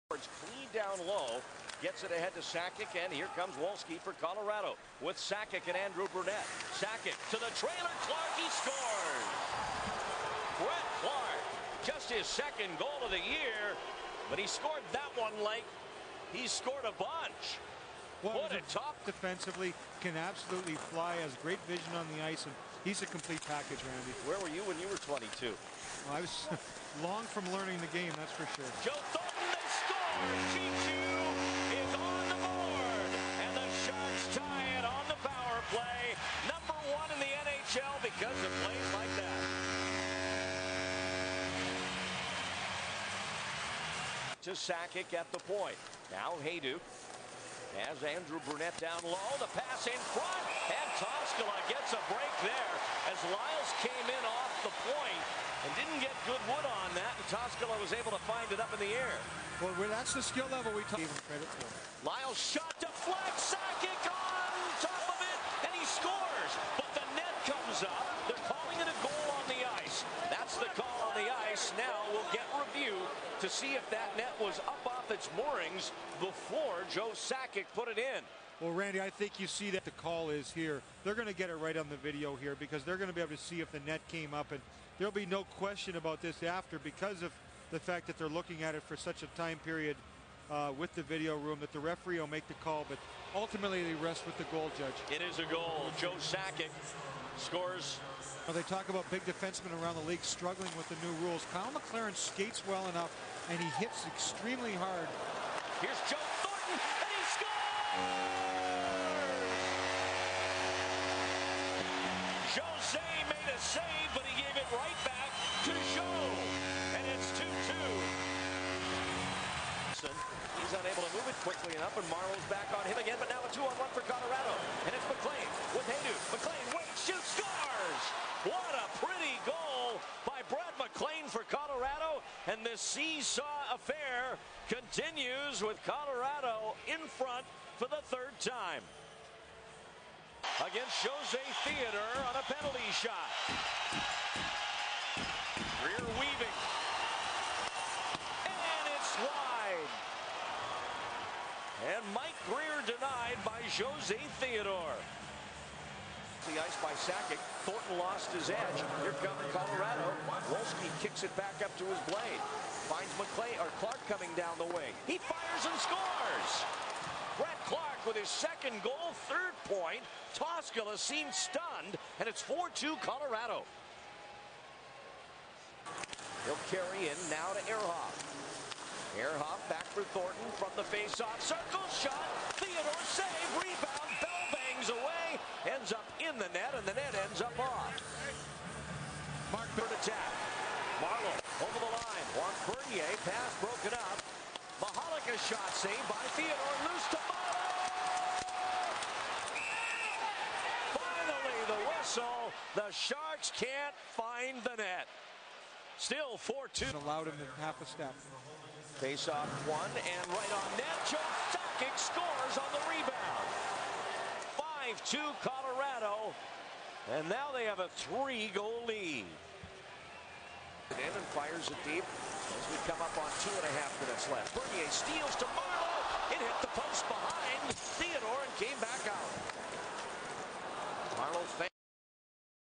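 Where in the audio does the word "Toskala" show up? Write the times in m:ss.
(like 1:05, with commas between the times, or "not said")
0:57, 2:50.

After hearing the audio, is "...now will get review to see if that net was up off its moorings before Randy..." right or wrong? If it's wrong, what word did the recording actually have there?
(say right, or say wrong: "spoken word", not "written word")
wrong: "Joe", not "Randy".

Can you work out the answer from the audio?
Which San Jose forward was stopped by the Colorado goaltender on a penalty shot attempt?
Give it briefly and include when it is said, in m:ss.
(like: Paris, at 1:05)
Mike Grier, at 2:32.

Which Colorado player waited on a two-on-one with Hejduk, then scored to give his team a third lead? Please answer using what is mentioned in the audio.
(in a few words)
Brett McLean.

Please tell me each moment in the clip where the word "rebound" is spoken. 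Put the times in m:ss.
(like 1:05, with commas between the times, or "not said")
3:03, 3:32.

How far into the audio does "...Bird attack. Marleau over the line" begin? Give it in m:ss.
3:09.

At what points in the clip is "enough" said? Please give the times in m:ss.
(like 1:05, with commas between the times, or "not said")
1:42, 2:01.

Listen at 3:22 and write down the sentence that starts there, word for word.
The Sharks can't find the net.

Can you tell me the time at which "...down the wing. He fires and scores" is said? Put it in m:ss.
2:44.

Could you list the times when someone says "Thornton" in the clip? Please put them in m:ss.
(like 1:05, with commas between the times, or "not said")
1:46, 2:37, 3:00.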